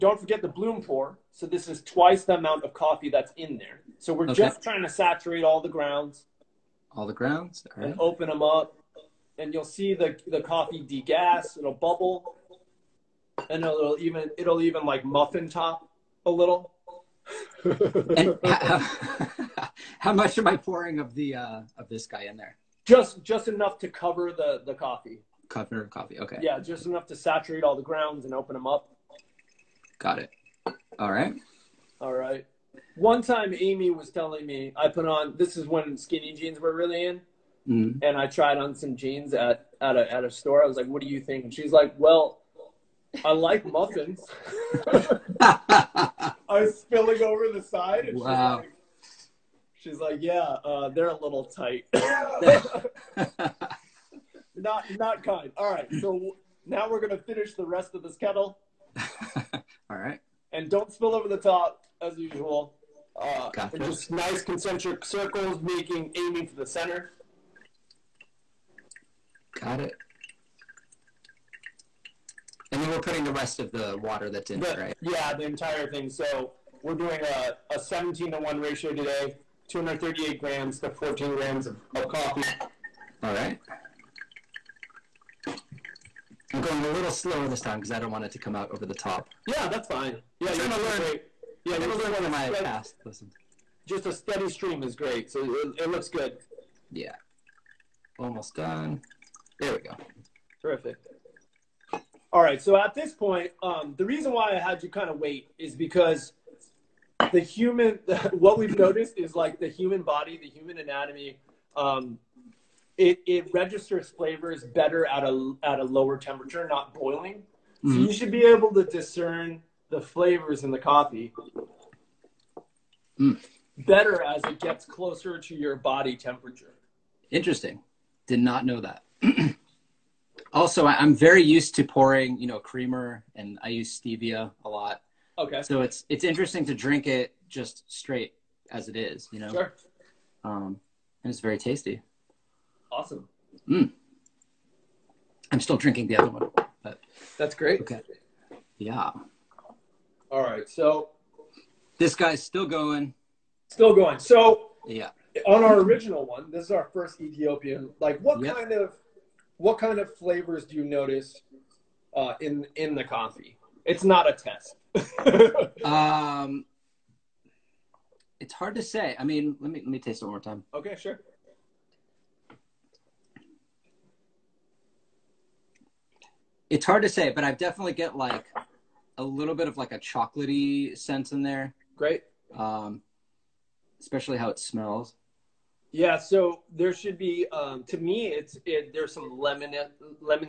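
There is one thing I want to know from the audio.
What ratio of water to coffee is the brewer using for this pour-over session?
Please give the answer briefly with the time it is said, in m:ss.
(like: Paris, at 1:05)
17 to 1, at 1:17.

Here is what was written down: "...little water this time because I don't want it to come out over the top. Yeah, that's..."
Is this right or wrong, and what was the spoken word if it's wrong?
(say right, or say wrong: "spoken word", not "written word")
wrong: "slower", not "water".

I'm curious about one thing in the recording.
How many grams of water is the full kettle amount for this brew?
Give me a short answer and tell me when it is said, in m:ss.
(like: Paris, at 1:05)
238 grams, at 1:19.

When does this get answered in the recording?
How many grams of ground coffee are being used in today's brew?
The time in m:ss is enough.
1:20.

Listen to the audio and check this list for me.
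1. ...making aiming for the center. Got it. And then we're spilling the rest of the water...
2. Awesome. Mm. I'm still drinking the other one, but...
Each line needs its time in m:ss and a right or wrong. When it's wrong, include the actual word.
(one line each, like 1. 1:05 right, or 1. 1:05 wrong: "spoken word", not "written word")
1. 1:05 wrong: "putting", not "spilling"
2. 2:22 right.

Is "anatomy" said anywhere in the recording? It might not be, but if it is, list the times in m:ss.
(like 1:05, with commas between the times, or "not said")
1:50.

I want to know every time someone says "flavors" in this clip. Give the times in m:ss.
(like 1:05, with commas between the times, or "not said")
1:54, 2:00, 2:40.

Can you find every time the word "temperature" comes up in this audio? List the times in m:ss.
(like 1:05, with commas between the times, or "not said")
1:56, 2:06.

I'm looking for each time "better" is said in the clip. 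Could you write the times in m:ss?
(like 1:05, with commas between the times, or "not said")
1:54, 2:03.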